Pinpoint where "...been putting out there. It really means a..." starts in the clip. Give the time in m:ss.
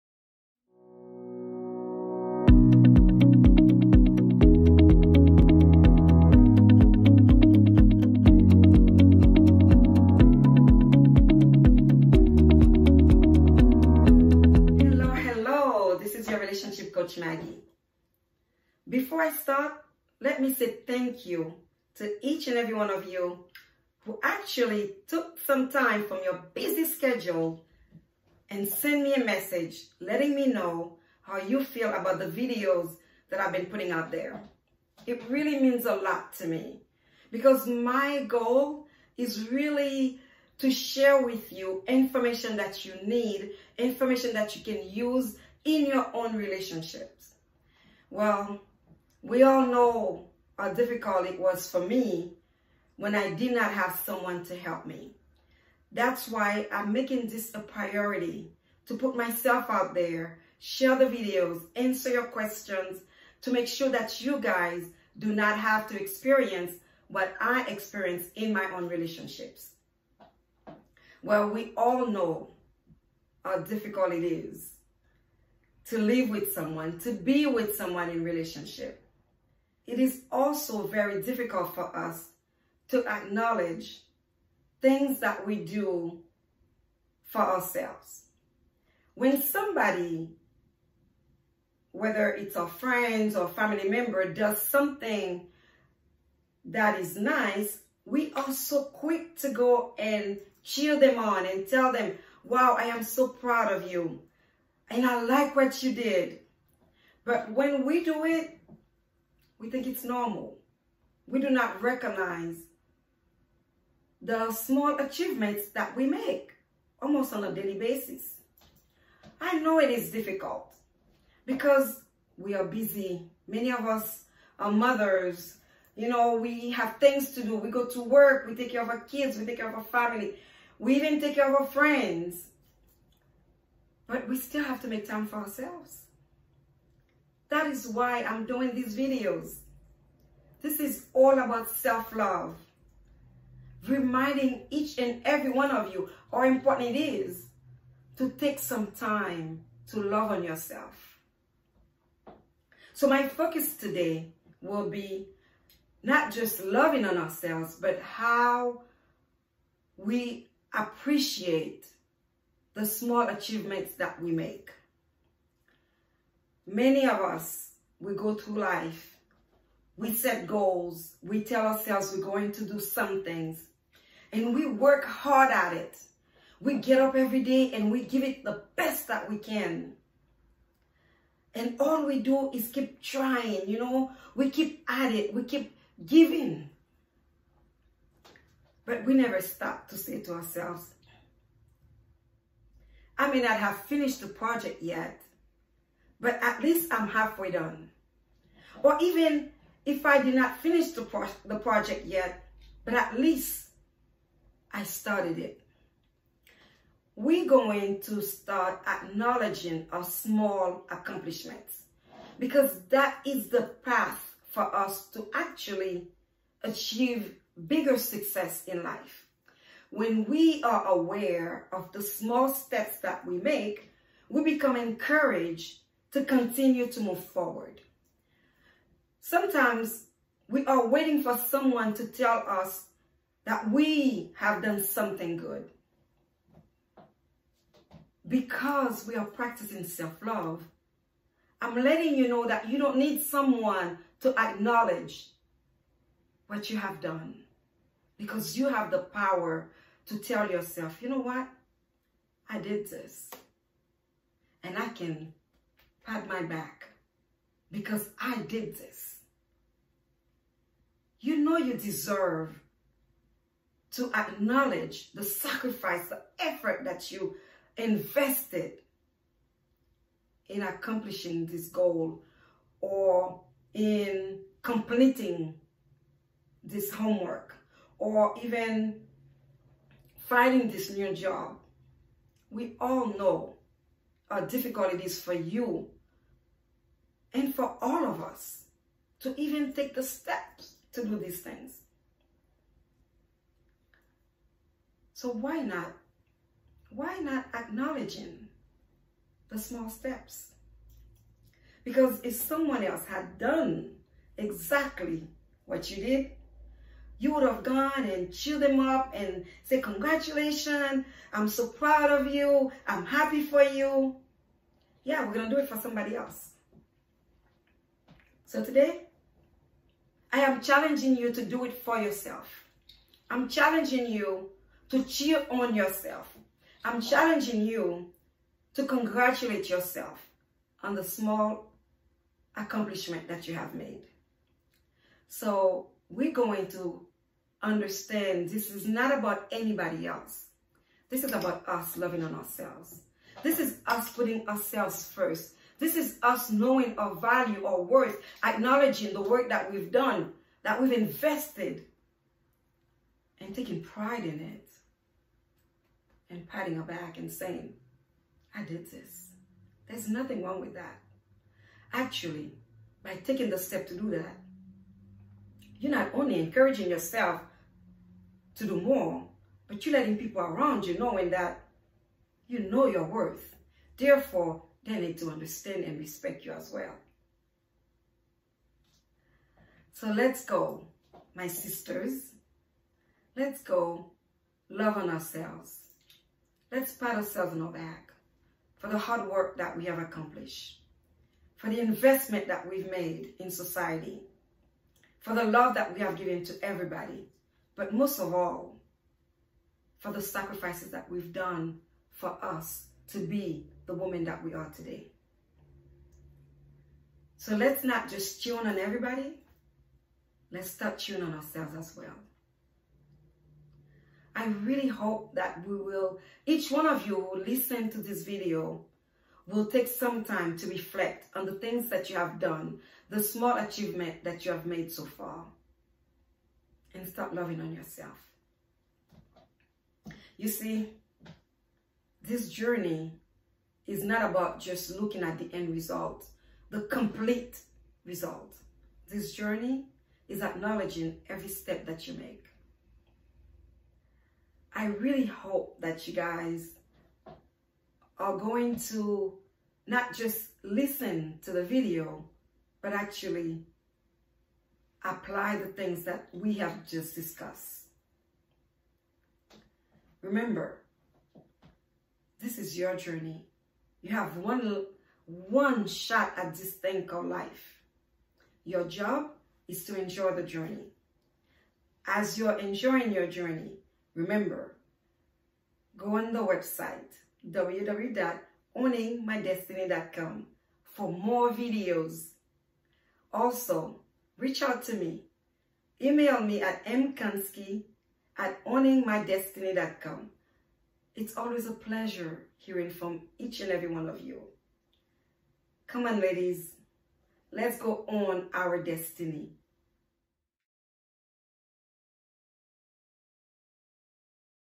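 0:33.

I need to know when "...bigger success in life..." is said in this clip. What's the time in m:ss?
3:37.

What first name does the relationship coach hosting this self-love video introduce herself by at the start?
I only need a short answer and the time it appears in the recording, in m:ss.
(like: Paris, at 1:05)
Maggie, at 0:17.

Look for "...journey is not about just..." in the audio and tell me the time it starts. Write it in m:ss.
7:12.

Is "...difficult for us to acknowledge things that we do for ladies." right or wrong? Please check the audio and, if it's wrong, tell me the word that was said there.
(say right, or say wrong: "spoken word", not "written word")
wrong: "ourselves", not "ladies".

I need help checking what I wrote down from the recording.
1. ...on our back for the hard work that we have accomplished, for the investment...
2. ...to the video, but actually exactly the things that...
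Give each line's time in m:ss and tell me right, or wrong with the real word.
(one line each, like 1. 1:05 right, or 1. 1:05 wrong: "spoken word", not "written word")
1. 6:27 right
2. 7:31 wrong: "apply", not "exactly".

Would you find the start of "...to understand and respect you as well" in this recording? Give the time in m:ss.
6:15.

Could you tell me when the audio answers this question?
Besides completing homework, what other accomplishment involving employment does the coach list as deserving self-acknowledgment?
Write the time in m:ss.
4:40.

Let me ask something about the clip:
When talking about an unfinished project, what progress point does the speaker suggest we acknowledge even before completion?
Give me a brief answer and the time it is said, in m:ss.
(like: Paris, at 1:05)
halfway done, at 3:17.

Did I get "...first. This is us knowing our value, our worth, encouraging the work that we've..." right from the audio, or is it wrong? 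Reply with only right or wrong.
wrong.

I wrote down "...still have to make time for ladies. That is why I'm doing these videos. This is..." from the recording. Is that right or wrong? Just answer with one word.
wrong.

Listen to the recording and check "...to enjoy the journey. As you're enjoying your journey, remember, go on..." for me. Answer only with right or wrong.
right.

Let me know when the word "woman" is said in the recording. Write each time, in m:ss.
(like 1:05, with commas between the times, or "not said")
6:43.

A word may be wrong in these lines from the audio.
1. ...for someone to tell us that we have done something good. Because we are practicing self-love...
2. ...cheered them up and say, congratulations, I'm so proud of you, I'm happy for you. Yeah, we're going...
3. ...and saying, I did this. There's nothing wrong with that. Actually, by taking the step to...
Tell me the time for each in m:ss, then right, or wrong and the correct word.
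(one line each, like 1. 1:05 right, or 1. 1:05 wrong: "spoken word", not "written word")
1. 3:51 right
2. 5:08 right
3. 5:57 right.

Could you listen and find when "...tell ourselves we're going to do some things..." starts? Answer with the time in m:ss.
2:51.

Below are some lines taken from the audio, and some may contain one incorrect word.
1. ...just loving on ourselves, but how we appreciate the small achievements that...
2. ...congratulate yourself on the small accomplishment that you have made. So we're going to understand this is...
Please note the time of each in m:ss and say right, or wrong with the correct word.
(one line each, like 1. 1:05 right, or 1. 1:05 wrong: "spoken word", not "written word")
1. 2:36 right
2. 5:28 right.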